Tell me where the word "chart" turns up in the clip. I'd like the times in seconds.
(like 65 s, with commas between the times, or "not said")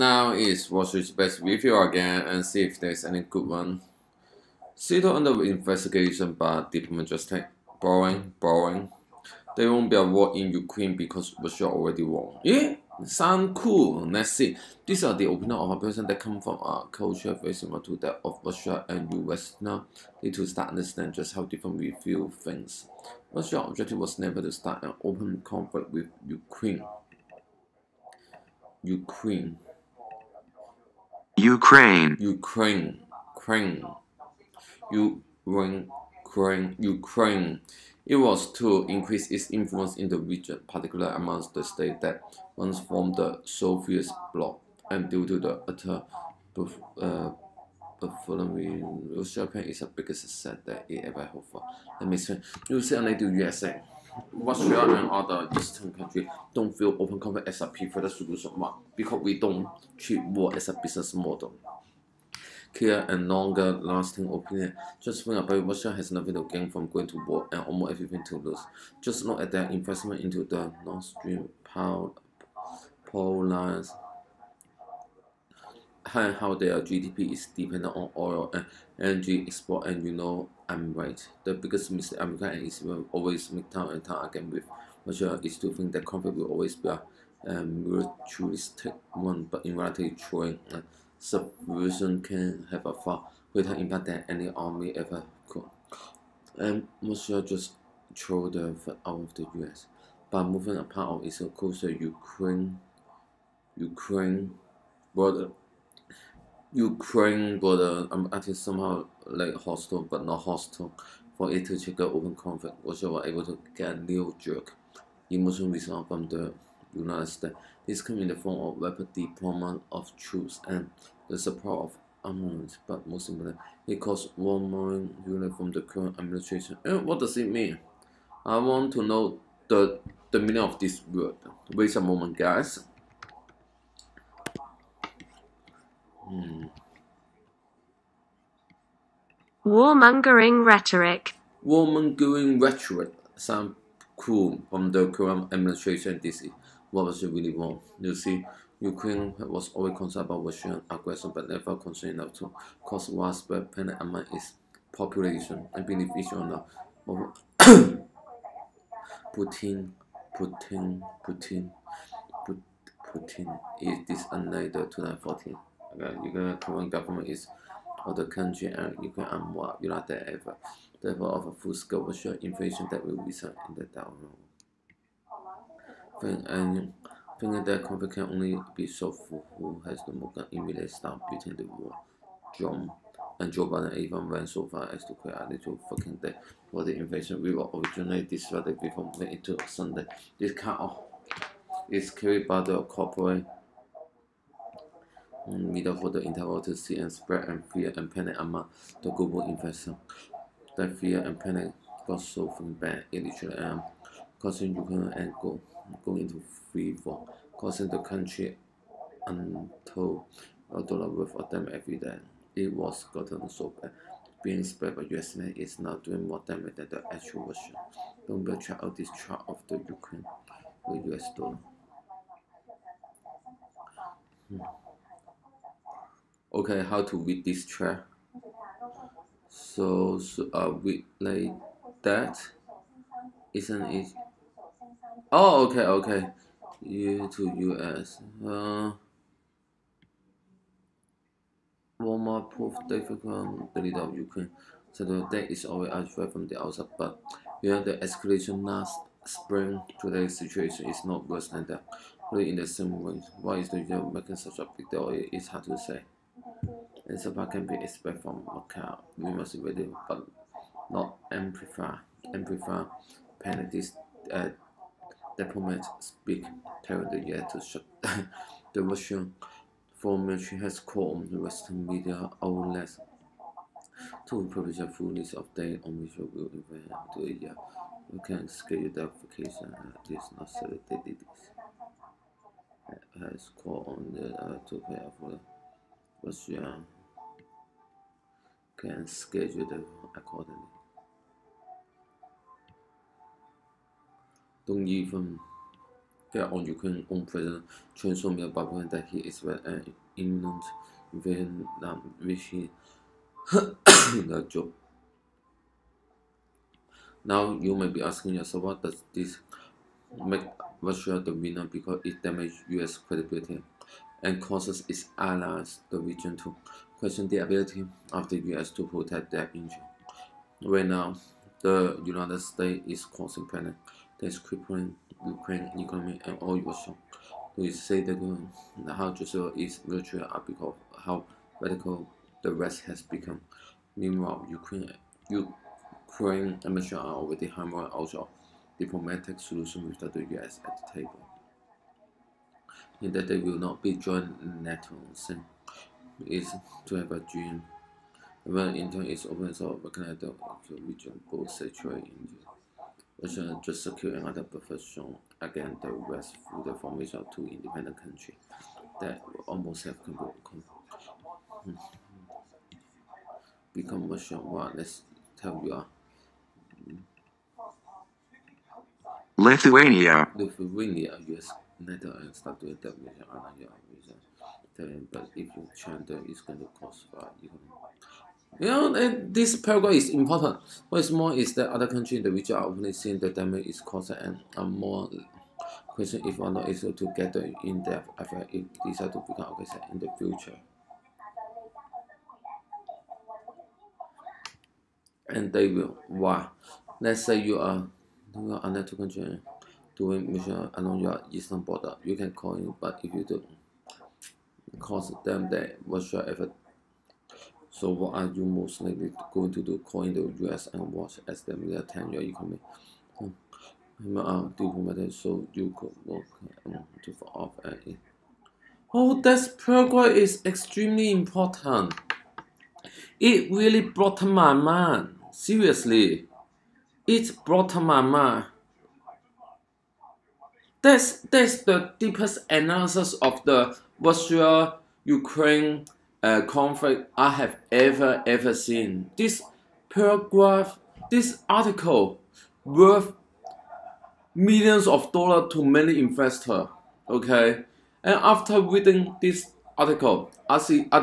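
219 s, 227 s.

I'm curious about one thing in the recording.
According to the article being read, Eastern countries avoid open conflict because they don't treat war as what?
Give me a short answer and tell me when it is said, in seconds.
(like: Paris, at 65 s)
A business model, at 60 s.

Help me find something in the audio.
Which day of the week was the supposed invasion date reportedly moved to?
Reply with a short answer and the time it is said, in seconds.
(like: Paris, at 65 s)
Sunday, at 189 s.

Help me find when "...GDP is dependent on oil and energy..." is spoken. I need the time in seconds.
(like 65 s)
76 s.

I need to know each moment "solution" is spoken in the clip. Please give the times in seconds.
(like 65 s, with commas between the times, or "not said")
58 s, 339 s.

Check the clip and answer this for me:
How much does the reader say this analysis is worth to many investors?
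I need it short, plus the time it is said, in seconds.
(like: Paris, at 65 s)
Millions of dollars, at 444 s.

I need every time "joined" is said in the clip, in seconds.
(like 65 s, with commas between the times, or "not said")
343 s.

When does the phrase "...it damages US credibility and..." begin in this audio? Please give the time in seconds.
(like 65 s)
312 s.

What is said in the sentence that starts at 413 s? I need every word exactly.
Um, uh, diplomatic, so you could work um, to off at it.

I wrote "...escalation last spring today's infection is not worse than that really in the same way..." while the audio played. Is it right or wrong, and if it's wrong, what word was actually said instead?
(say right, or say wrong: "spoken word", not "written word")
wrong: "situation", not "infection".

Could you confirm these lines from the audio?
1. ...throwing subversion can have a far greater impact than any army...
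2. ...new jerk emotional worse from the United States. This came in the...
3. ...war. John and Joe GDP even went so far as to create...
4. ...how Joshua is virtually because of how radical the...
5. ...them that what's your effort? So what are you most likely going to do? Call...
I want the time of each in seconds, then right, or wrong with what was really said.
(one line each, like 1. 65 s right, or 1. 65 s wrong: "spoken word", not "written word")
1. 90 s right
2. 113 s wrong: "response", not "worse"
3. 181 s wrong: "Biden", not "GDP"
4. 328 s right
5. 405 s right.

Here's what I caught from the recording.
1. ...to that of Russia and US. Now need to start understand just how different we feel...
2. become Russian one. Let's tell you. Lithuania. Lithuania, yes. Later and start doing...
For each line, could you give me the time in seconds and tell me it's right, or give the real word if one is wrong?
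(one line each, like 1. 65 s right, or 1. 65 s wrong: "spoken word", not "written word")
1. 17 s right
2. 363 s right.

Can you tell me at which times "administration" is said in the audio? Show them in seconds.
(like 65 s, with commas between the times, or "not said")
126 s, 145 s.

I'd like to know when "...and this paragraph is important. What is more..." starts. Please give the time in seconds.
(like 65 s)
378 s.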